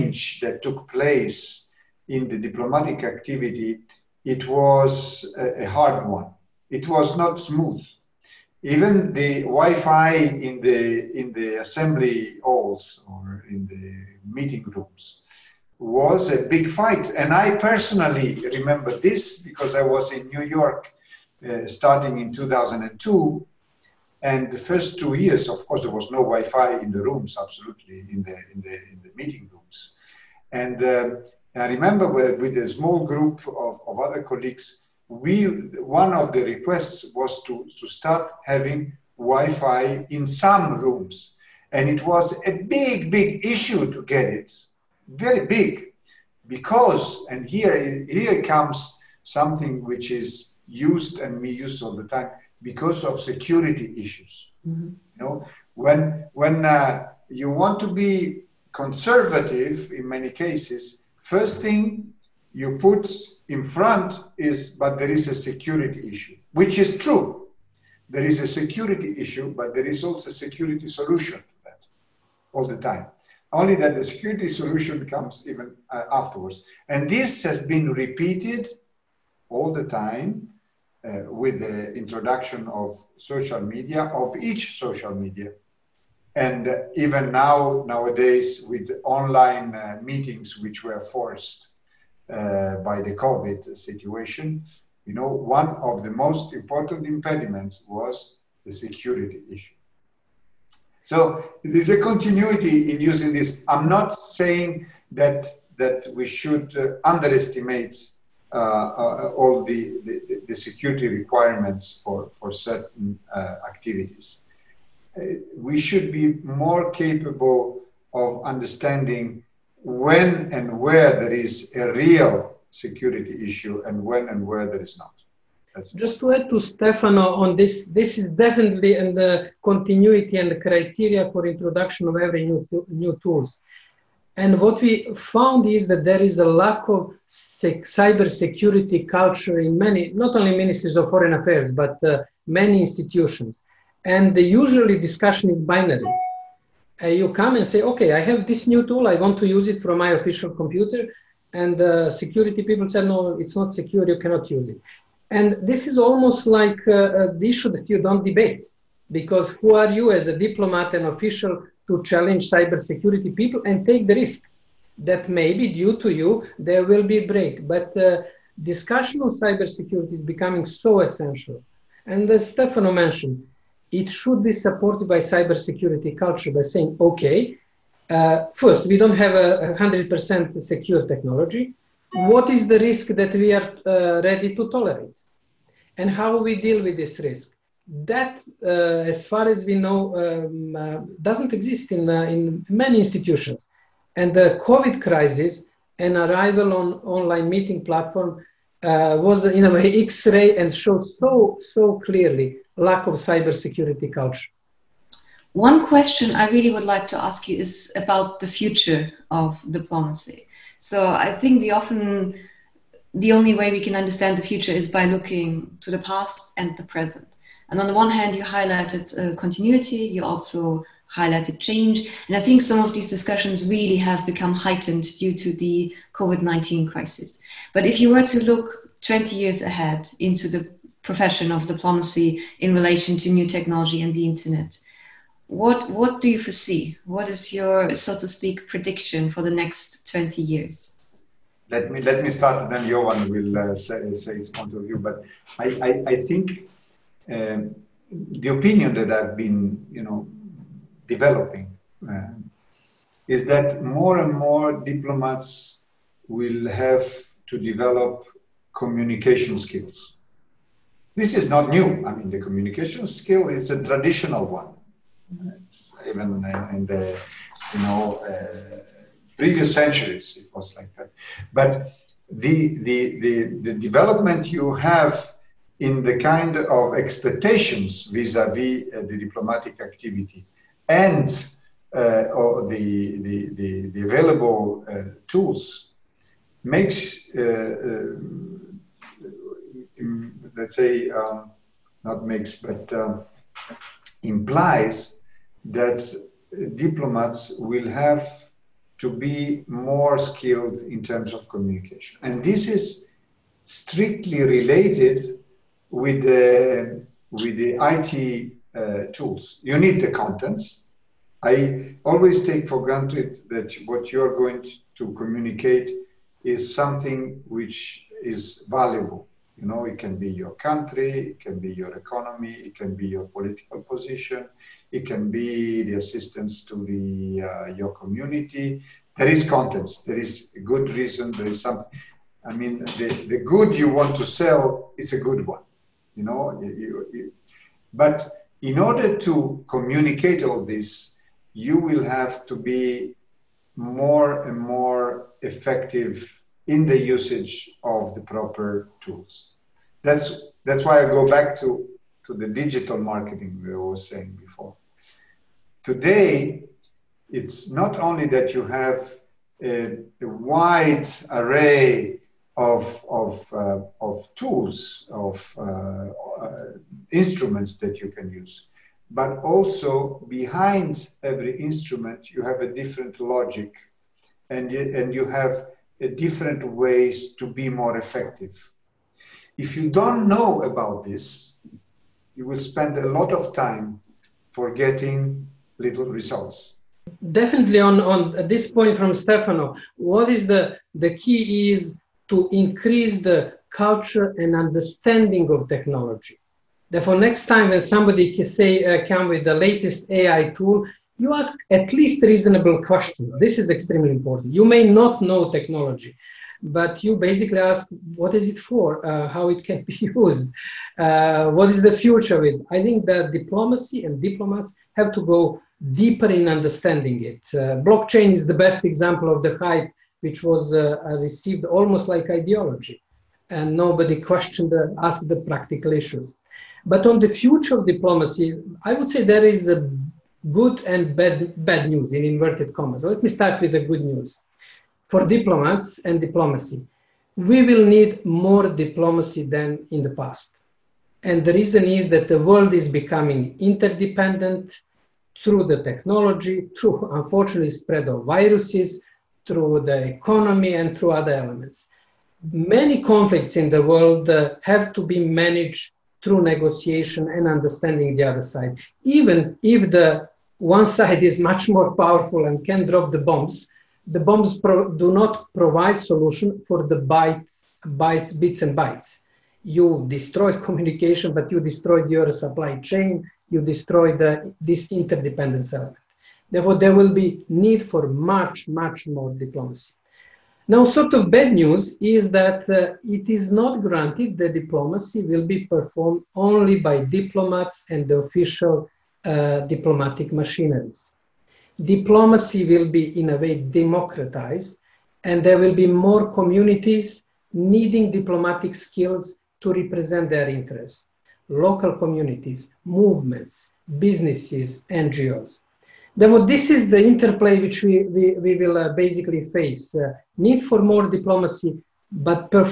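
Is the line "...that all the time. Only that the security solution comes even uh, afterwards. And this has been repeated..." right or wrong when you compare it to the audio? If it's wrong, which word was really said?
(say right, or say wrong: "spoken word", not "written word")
right.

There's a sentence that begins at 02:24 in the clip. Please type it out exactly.
And the usually discussion is binary.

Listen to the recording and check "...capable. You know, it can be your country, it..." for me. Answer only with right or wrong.
wrong.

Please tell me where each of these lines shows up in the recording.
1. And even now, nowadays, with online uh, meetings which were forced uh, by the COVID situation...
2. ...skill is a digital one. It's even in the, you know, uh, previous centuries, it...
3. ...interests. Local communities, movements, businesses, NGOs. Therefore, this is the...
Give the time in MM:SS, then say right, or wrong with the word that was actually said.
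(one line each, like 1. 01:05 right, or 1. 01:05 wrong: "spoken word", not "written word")
1. 01:26 right
2. 04:23 wrong: "traditional", not "digital"
3. 08:20 right.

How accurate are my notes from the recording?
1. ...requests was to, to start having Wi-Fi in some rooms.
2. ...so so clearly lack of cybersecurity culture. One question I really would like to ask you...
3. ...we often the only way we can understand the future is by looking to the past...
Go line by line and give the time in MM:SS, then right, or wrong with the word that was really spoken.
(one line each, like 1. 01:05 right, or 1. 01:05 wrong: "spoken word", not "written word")
1. 00:36 right
2. 03:21 right
3. 03:31 right.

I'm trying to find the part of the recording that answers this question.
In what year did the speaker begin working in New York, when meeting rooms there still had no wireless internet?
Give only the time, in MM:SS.
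00:22.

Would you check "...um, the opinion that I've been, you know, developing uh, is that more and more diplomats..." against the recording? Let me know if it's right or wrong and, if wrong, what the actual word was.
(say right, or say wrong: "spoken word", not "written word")
right.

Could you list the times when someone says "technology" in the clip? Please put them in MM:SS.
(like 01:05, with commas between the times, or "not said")
03:01, 03:53, 06:35, 06:45, 07:25.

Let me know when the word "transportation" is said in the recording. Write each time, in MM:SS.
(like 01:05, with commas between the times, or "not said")
not said.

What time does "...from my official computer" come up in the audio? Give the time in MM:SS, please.
02:29.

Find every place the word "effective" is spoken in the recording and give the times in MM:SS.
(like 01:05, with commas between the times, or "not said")
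05:45, 06:17.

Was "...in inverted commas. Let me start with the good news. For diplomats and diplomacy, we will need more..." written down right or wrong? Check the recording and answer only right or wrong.
right.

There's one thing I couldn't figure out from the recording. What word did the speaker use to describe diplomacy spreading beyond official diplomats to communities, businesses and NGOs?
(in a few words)
Democratized.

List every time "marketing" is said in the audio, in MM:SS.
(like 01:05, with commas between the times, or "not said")
05:52.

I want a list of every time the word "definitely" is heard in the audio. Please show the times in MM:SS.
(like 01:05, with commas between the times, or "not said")
02:08, 06:27.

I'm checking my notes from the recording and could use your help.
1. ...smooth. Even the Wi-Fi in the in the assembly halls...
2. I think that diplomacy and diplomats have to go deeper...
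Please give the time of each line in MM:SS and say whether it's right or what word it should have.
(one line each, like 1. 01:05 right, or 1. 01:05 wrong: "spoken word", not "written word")
1. 00:07 right
2. 06:52 right.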